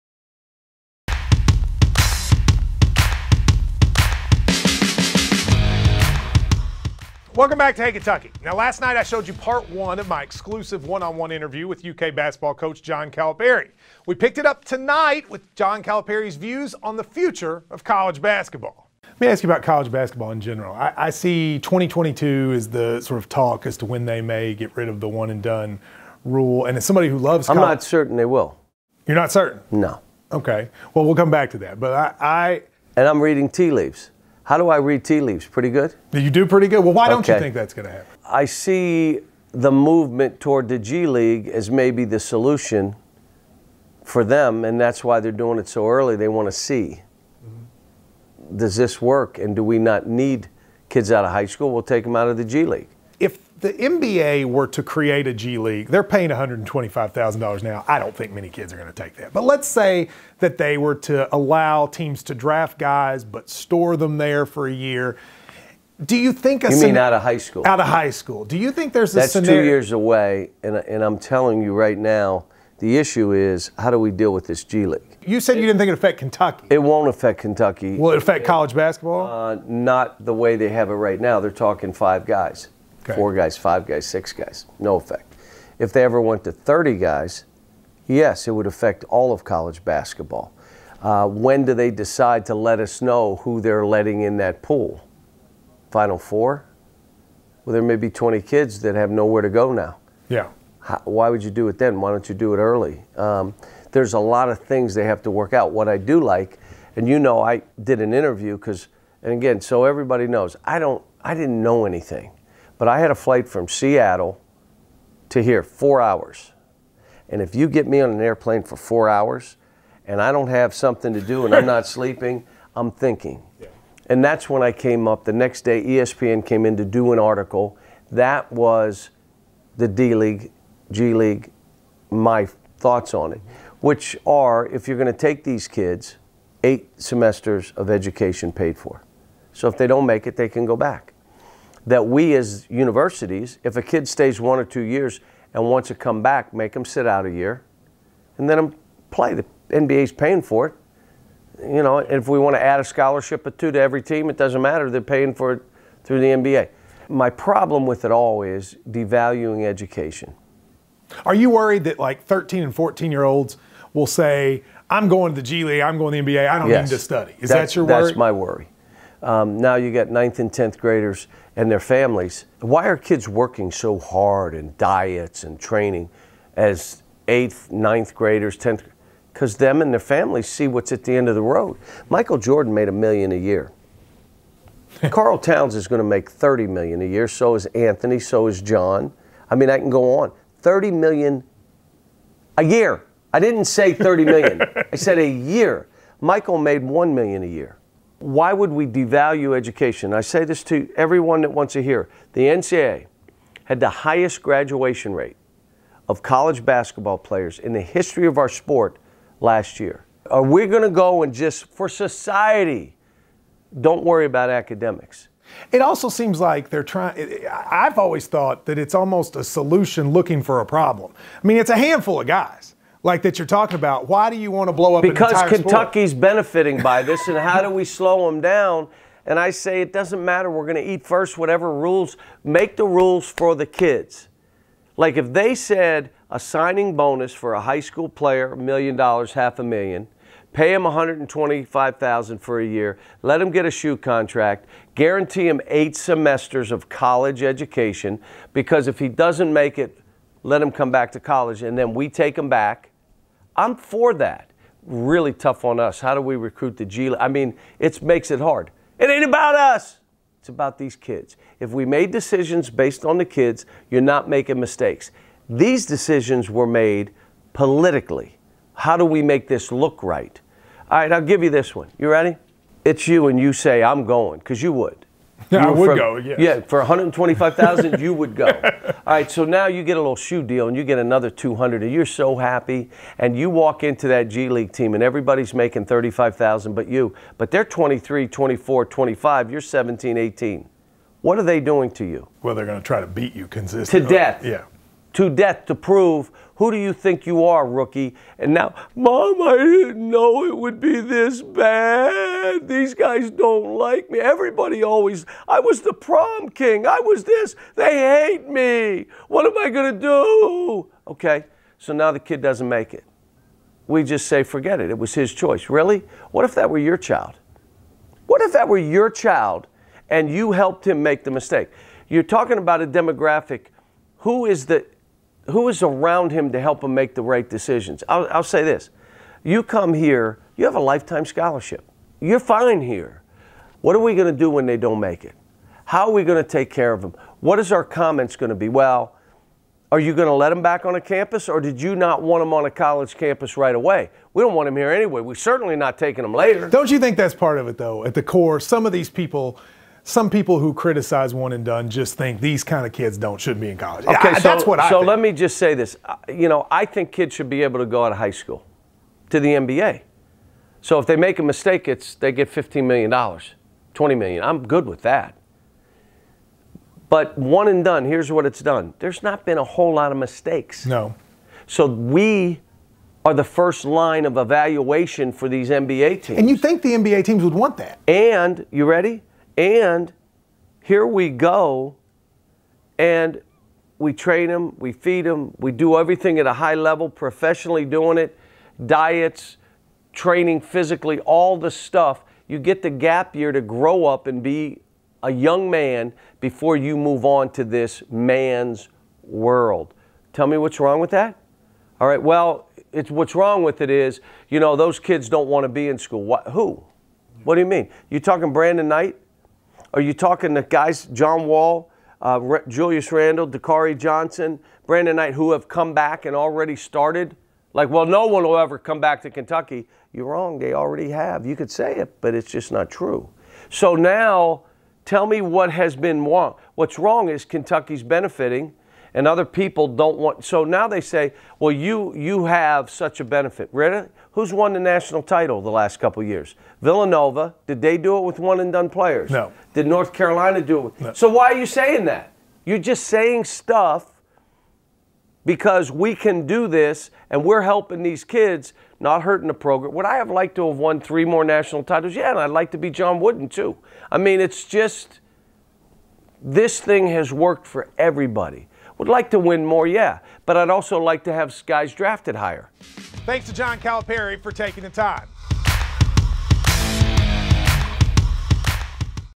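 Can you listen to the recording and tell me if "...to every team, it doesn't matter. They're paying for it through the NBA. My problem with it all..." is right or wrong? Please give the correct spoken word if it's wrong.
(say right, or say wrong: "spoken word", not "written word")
right.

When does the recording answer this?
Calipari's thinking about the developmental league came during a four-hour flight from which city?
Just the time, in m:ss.
1:53.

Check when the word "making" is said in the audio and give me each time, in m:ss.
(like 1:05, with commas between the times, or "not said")
4:24, 4:45.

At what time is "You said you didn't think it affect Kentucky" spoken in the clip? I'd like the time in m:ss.
1:15.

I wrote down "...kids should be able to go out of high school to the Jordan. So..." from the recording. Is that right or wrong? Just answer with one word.
wrong.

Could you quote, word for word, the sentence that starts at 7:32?
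Yeah, and I'd like to be John Wooden too.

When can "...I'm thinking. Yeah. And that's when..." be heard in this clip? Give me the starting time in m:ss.
2:02.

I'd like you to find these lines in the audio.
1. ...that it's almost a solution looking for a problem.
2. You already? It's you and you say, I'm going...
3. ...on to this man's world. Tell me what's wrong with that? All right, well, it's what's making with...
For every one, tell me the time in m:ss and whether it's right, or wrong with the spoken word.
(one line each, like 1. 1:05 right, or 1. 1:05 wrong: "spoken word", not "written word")
1. 3:38 right
2. 4:31 wrong: "ready", not "already"
3. 6:37 wrong: "wrong", not "making".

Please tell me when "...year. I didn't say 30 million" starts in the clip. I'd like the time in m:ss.
3:12.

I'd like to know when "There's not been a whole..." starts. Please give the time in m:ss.
6:08.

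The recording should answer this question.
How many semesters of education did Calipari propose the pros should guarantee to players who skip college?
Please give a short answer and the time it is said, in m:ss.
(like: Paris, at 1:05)
8, at 2:16.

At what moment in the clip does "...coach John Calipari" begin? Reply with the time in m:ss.
0:12.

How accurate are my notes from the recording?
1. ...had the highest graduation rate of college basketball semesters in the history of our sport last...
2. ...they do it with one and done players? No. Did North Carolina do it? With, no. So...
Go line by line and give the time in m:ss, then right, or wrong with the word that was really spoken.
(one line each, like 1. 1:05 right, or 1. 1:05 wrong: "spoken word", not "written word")
1. 3:23 wrong: "players", not "semesters"
2. 7:17 right.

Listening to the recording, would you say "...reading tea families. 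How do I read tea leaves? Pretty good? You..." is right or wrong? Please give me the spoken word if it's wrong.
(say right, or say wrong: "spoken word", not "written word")
wrong: "leaves", not "families".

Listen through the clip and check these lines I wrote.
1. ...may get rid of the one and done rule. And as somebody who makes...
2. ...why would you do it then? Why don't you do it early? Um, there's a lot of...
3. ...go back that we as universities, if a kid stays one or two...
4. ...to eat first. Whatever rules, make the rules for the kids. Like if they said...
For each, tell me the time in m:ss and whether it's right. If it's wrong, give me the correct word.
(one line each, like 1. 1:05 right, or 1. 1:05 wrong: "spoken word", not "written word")
1. 0:24 wrong: "loves", not "makes"
2. 1:41 right
3. 2:20 right
4. 3:50 right.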